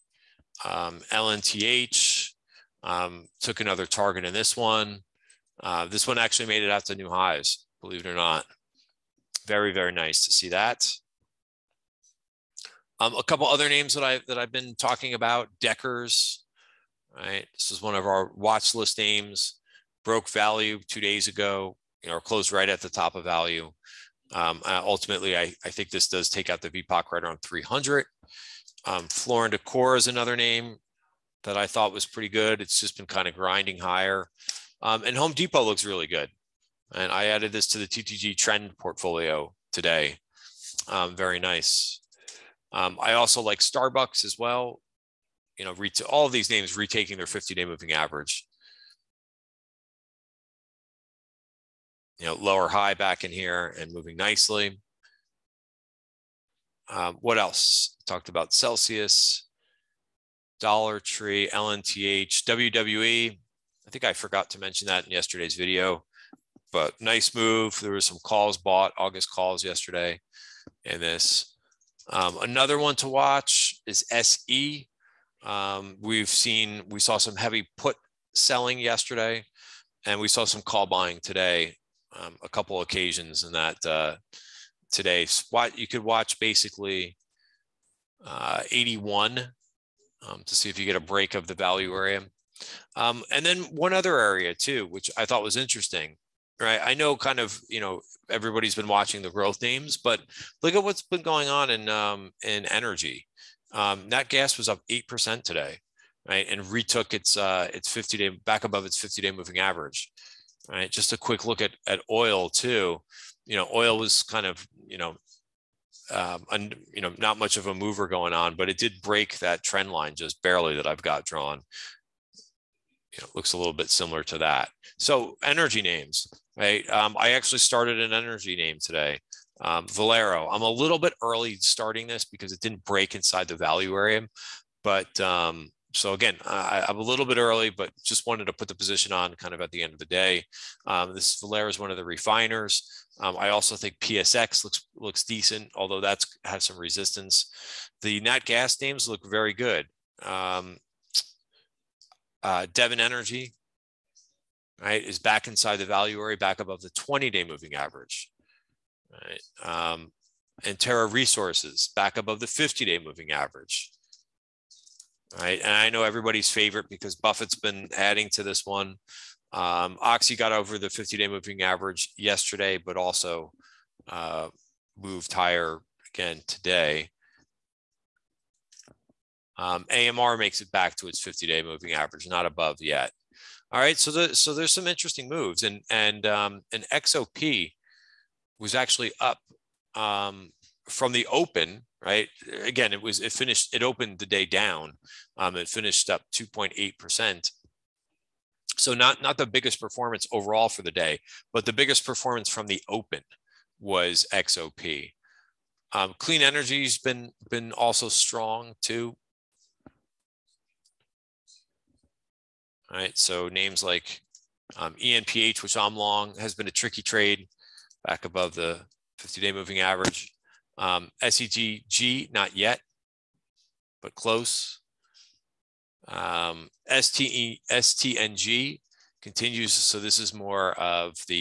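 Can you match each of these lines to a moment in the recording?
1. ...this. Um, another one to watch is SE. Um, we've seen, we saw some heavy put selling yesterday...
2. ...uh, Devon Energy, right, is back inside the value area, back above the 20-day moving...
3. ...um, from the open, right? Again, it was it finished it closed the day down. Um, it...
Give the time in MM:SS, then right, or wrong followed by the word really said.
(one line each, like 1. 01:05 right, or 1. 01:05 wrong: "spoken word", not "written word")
1. 01:11 right
2. 02:32 right
3. 03:09 wrong: "opened", not "closed".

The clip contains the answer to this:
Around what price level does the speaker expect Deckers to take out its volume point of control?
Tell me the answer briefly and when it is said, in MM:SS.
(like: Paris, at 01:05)
300, at 00:27.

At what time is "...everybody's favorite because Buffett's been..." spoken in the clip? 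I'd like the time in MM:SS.
02:46.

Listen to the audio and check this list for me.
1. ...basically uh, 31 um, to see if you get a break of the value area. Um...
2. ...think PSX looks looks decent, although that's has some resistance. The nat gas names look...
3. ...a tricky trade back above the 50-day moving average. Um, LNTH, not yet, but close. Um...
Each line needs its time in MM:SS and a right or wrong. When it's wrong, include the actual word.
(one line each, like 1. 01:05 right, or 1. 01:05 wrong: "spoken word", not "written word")
1. 01:26 wrong: "81", not "31"
2. 02:23 right
3. 03:36 wrong: "SEDG", not "LNTH".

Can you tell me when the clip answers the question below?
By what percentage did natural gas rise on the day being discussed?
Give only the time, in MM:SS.
01:44.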